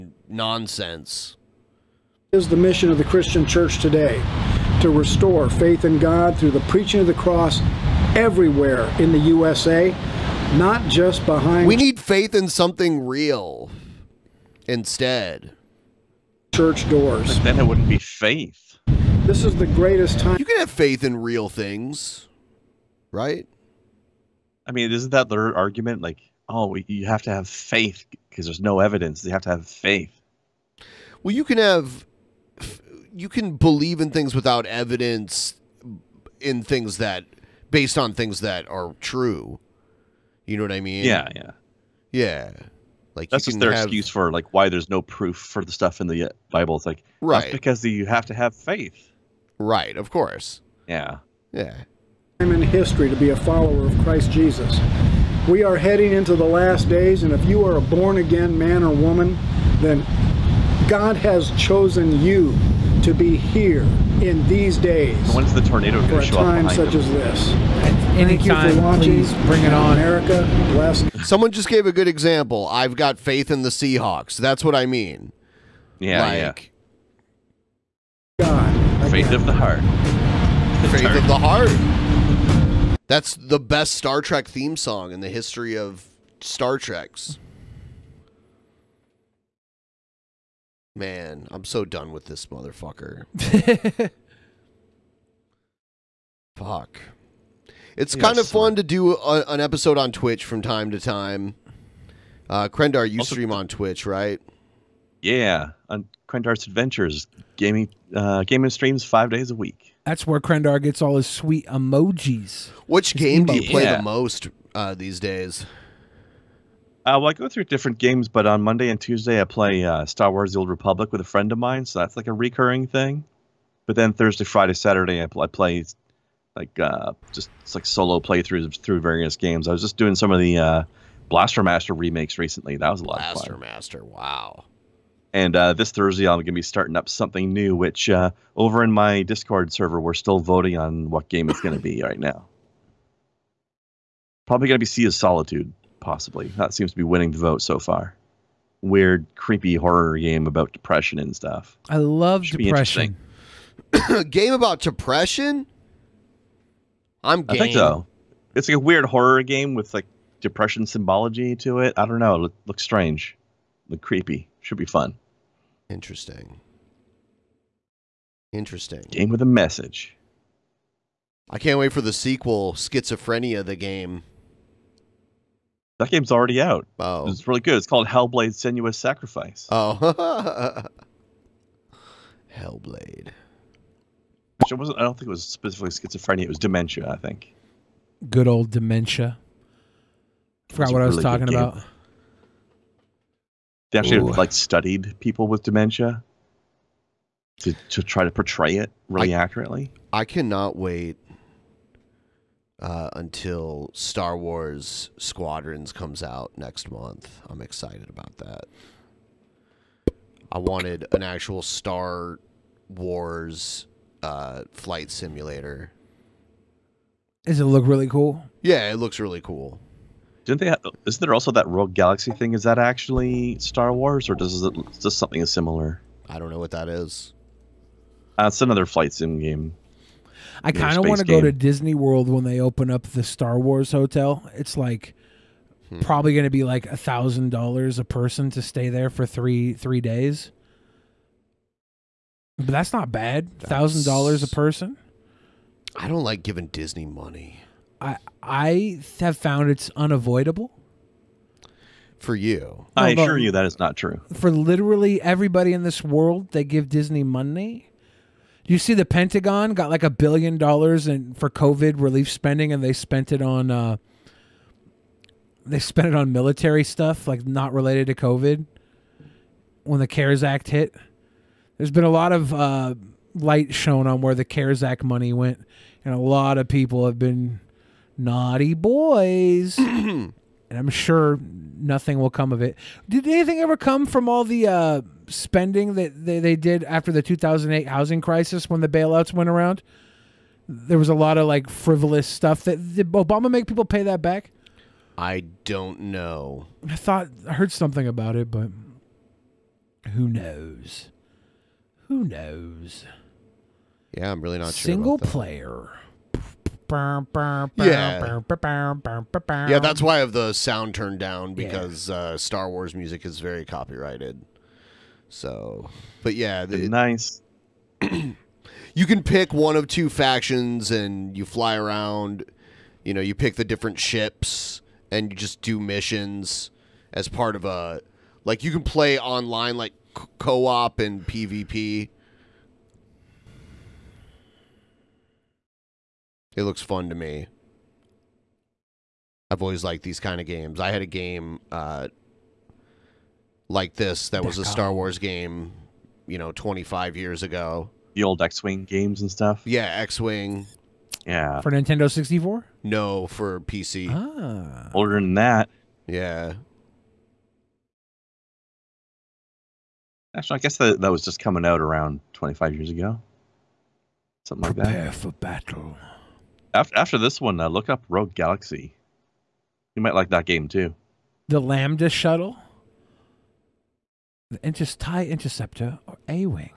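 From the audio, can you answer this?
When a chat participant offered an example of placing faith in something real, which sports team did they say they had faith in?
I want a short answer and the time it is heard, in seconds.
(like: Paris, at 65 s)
Seahawks, at 73 s.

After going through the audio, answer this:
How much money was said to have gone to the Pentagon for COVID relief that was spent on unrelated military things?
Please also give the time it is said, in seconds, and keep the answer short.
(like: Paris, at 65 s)
a billion dollars, at 260 s.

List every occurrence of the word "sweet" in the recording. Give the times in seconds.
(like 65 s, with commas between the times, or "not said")
111 s.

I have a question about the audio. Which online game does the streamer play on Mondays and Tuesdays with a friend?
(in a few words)
Star Wars: The Old Republic.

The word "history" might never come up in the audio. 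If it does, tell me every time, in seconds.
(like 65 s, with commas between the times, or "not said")
52 s, 85 s.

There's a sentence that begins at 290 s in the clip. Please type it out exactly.
There was a lot of like frivolous stuff that did Obama make people pay that back.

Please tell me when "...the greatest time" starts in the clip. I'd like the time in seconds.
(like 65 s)
19 s.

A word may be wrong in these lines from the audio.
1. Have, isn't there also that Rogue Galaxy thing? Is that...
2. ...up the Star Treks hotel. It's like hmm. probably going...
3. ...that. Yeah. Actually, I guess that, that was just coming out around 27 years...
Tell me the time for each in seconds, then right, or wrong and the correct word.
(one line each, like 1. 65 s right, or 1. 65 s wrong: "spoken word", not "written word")
1. 220 s right
2. 232 s wrong: "Wars", not "Treks"
3. 355 s wrong: "25", not "27".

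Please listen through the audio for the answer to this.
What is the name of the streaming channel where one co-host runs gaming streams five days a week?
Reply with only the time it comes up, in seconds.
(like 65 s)
106 s.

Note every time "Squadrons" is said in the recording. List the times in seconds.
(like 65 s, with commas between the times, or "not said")
205 s.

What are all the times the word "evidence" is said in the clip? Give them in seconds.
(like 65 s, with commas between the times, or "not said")
28 s, 34 s.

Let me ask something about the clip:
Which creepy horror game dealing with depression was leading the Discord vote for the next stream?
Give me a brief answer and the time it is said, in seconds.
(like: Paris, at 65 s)
Sea of Solitude, at 144 s.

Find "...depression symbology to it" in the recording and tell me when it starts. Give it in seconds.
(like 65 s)
160 s.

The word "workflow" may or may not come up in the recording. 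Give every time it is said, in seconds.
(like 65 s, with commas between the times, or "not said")
not said.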